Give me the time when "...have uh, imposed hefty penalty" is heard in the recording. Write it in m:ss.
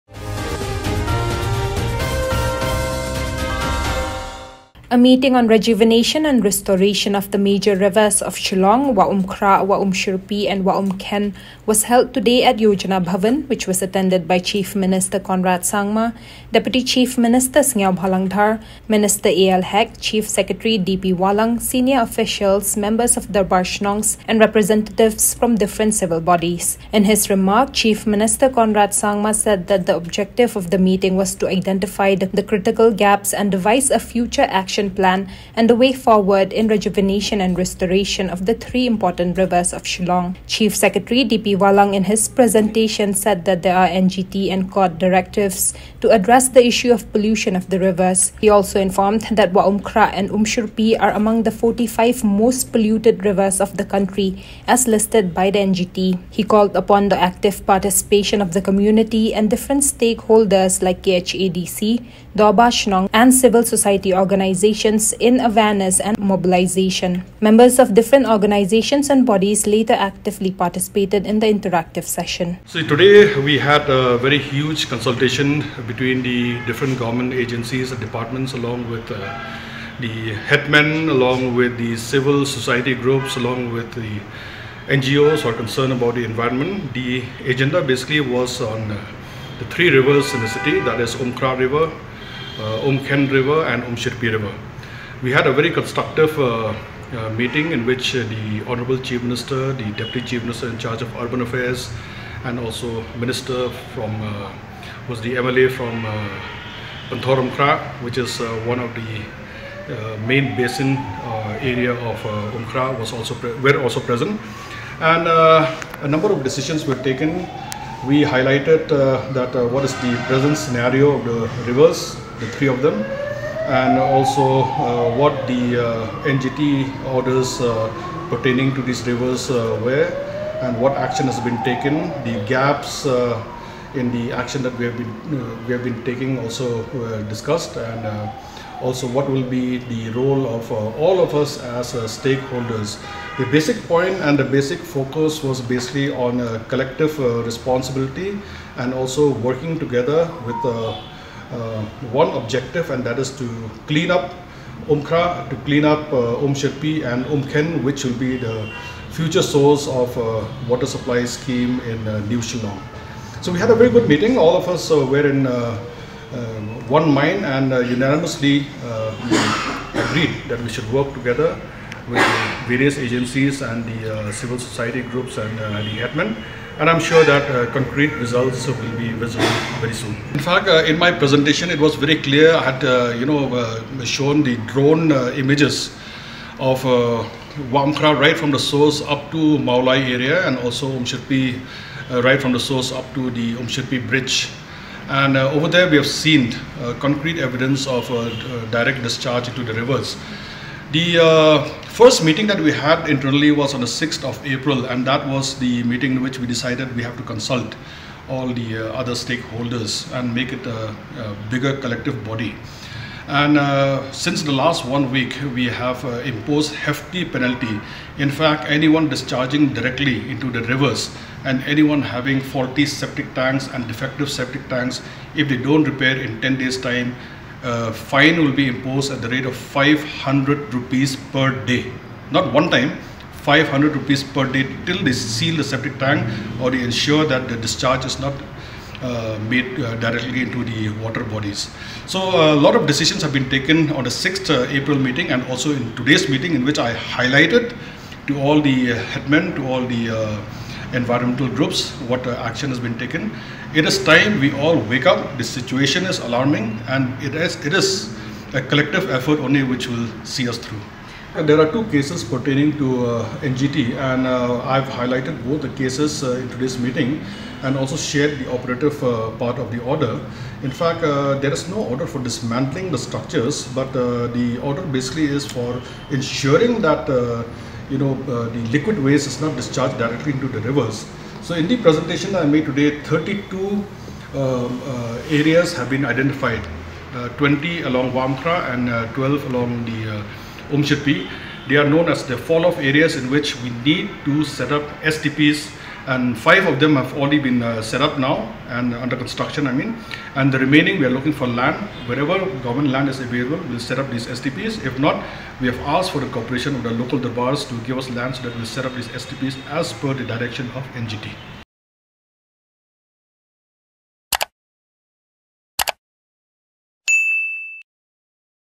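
3:35.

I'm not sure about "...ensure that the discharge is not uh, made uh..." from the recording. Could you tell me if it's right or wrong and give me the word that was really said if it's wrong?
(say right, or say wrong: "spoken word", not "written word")
right.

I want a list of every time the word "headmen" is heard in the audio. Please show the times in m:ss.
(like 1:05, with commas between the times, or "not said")
1:20, 2:56, 4:09.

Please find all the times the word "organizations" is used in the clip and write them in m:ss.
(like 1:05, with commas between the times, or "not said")
1:04, 1:08.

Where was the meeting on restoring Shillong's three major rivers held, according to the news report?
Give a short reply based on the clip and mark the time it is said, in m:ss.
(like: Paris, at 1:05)
Yojana Bhavan, at 0:12.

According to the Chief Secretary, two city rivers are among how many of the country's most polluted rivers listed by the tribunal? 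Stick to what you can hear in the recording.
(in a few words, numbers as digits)
45.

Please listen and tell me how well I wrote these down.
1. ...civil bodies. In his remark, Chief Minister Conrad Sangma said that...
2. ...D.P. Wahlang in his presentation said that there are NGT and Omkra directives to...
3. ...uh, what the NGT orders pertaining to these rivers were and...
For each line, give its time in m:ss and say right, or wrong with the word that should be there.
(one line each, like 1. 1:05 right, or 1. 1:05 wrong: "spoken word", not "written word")
1. 0:25 right
2. 0:41 wrong: "COD", not "Omkra"
3. 2:04 right.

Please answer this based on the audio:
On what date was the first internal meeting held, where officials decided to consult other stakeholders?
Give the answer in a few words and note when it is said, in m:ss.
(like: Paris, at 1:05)
6th of April, at 3:23.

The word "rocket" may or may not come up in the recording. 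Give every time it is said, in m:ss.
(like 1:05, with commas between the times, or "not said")
not said.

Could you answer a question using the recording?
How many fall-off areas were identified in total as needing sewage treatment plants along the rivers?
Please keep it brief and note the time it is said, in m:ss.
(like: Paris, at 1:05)
32, at 4:43.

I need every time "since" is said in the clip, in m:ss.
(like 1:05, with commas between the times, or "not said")
3:34.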